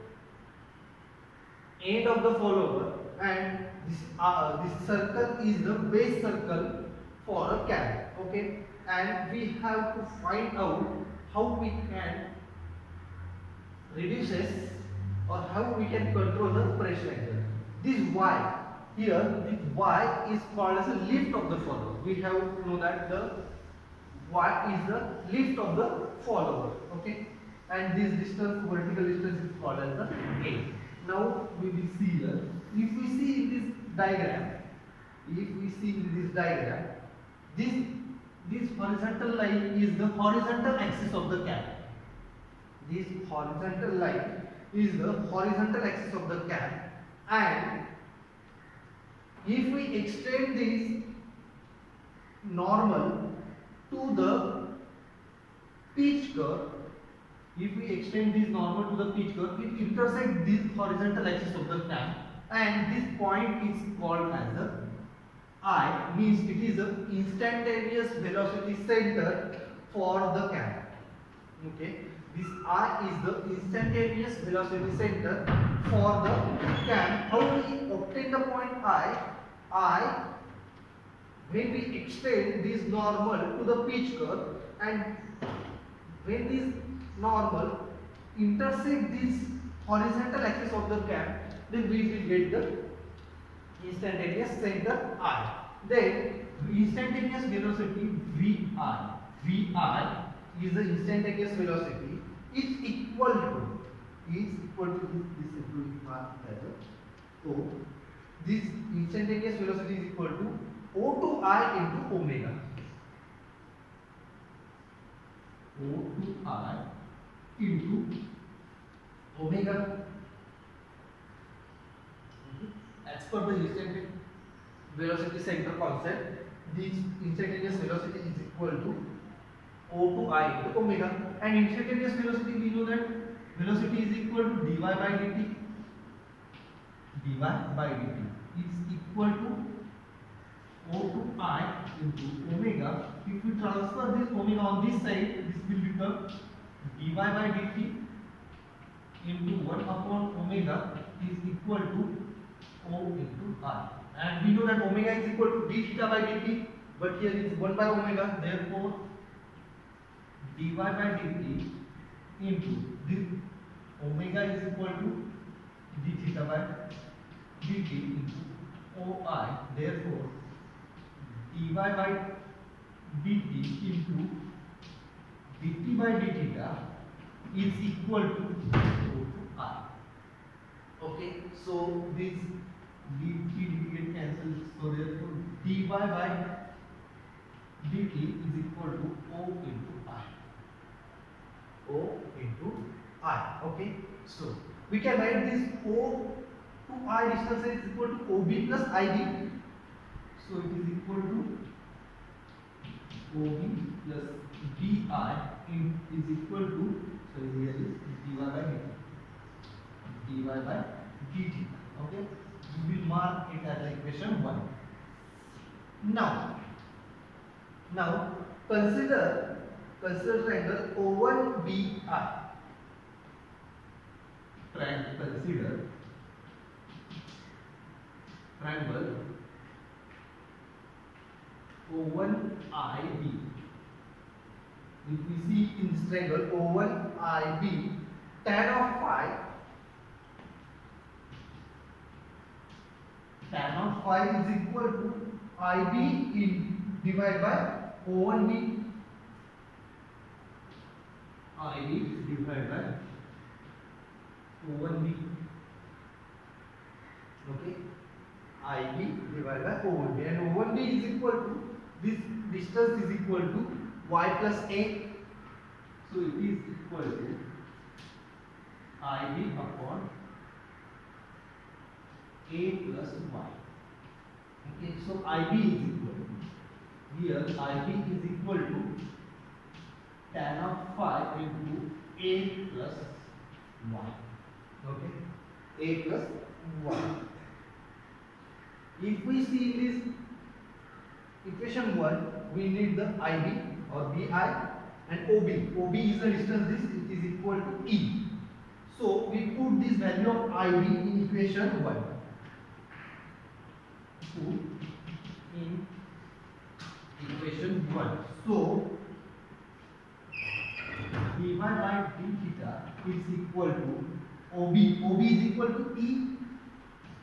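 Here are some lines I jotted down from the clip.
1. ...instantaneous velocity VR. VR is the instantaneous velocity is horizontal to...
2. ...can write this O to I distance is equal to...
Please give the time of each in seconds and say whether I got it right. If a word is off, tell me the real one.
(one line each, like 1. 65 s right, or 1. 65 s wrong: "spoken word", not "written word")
1. 96 s wrong: "equal", not "horizontal"
2. 195 s right.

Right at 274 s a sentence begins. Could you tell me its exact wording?
Okay, so ib is equal to here ib is equal to tan of phi into a plus y.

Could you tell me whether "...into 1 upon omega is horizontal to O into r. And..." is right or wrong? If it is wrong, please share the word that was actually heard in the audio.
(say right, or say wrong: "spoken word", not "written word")
wrong: "equal", not "horizontal".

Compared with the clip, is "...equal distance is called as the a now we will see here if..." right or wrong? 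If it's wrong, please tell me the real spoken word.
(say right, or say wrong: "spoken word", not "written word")
wrong: "vertical", not "equal".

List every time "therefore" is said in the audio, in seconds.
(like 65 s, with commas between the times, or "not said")
158 s, 169 s, 184 s.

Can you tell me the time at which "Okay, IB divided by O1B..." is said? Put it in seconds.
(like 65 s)
257 s.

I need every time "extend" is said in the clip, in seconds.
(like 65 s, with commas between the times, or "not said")
50 s, 57 s, 81 s.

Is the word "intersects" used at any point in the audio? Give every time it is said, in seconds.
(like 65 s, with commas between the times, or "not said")
59 s, 88 s.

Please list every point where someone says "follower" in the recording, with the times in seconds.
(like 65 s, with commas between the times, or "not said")
2 s, 21 s, 26 s.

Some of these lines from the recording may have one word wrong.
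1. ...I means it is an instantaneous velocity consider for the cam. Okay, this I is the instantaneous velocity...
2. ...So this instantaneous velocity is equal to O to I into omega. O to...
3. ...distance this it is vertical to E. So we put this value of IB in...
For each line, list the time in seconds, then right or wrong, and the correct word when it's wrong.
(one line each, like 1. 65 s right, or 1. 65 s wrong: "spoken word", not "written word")
1. 65 s wrong: "center", not "consider"
2. 107 s right
3. 296 s wrong: "equal", not "vertical".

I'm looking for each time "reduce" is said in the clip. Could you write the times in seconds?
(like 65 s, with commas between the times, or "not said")
13 s.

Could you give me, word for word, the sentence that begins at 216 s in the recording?
Now, now consider consider triangle O1 BR.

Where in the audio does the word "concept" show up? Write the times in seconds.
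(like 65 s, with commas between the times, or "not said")
125 s.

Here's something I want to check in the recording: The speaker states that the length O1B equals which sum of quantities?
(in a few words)
y plus a.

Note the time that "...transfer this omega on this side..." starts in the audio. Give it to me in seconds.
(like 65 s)
143 s.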